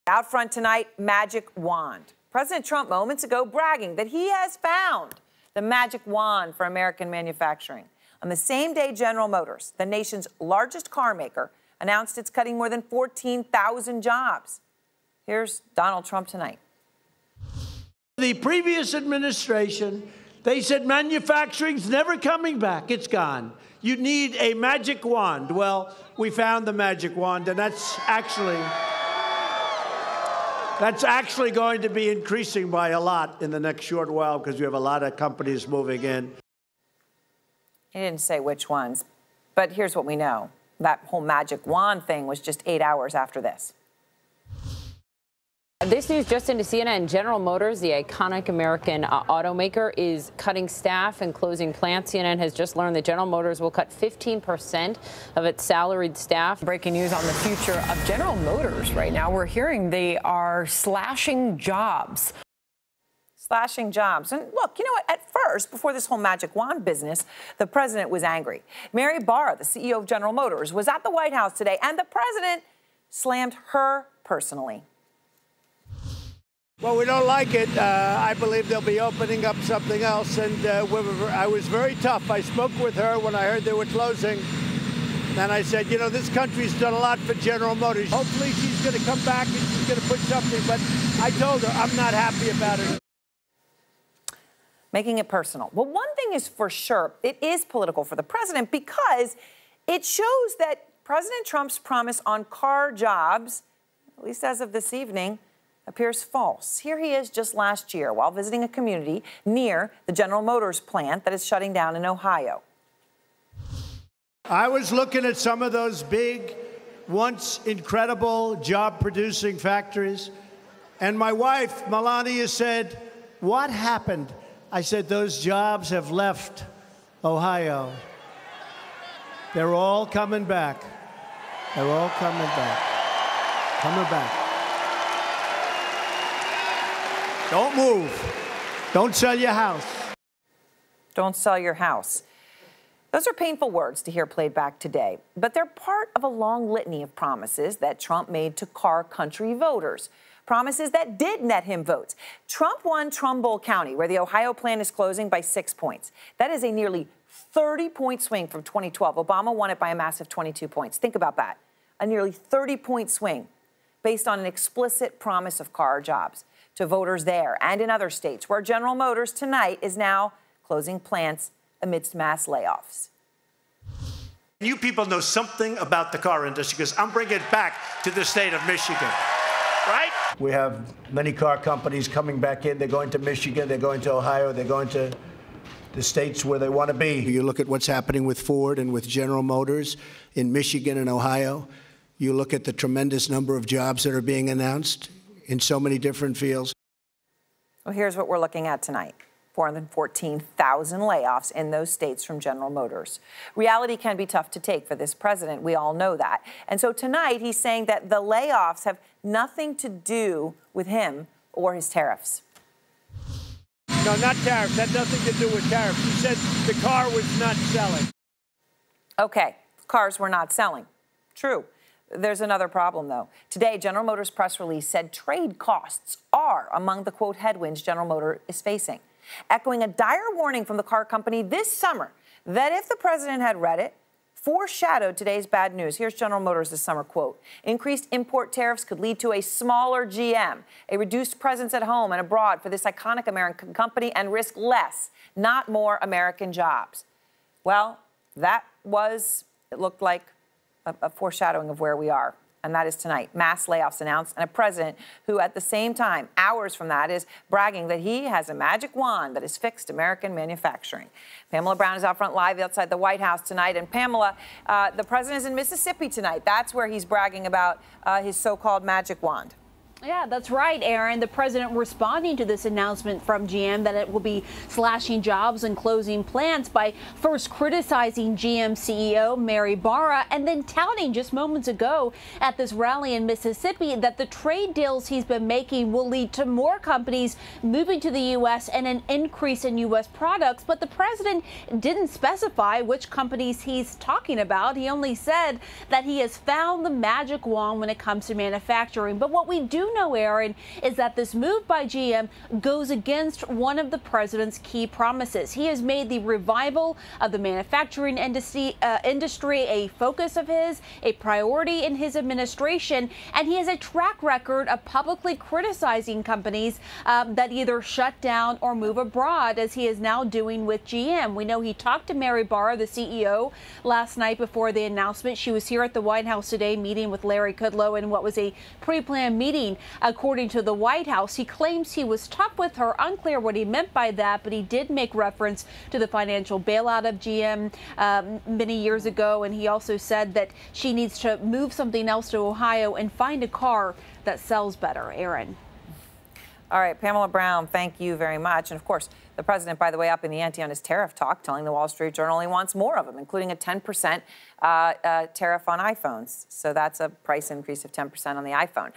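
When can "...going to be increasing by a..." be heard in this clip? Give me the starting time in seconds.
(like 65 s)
31 s.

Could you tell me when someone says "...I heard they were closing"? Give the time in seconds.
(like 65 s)
83 s.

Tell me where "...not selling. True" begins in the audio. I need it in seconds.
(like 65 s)
220 s.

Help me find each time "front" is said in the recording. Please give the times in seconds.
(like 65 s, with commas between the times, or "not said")
0 s, 262 s.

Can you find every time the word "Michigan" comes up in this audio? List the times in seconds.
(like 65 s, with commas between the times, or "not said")
178 s, 183 s, 190 s.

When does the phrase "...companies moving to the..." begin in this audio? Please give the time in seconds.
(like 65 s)
286 s.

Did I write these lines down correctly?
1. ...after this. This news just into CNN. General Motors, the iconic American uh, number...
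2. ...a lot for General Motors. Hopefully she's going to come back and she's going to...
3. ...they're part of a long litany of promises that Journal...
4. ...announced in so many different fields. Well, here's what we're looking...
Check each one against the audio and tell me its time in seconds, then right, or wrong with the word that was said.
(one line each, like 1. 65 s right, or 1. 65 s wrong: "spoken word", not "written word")
1. 43 s wrong: "automaker", not "number"
2. 86 s right
3. 145 s wrong: "Trump", not "Journal"
4. 194 s right.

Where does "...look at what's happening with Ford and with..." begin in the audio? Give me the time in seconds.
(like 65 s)
187 s.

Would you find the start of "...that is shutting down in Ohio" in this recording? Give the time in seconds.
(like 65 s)
111 s.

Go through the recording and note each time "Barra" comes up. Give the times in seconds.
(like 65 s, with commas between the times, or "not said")
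69 s, 279 s, 322 s.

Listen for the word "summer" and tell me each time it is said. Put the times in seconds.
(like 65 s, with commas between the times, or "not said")
231 s, 236 s.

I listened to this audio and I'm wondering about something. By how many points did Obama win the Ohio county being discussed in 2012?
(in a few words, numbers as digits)
22.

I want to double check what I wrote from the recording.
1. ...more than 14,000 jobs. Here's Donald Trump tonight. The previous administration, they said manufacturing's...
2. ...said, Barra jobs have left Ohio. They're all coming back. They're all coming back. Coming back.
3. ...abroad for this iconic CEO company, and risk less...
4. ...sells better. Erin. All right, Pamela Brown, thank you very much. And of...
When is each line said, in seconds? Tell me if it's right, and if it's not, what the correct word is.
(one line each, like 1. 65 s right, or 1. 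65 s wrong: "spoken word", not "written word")
1. 12 s right
2. 124 s wrong: "Those", not "Barra"
3. 242 s wrong: "American", not "CEO"
4. 344 s right.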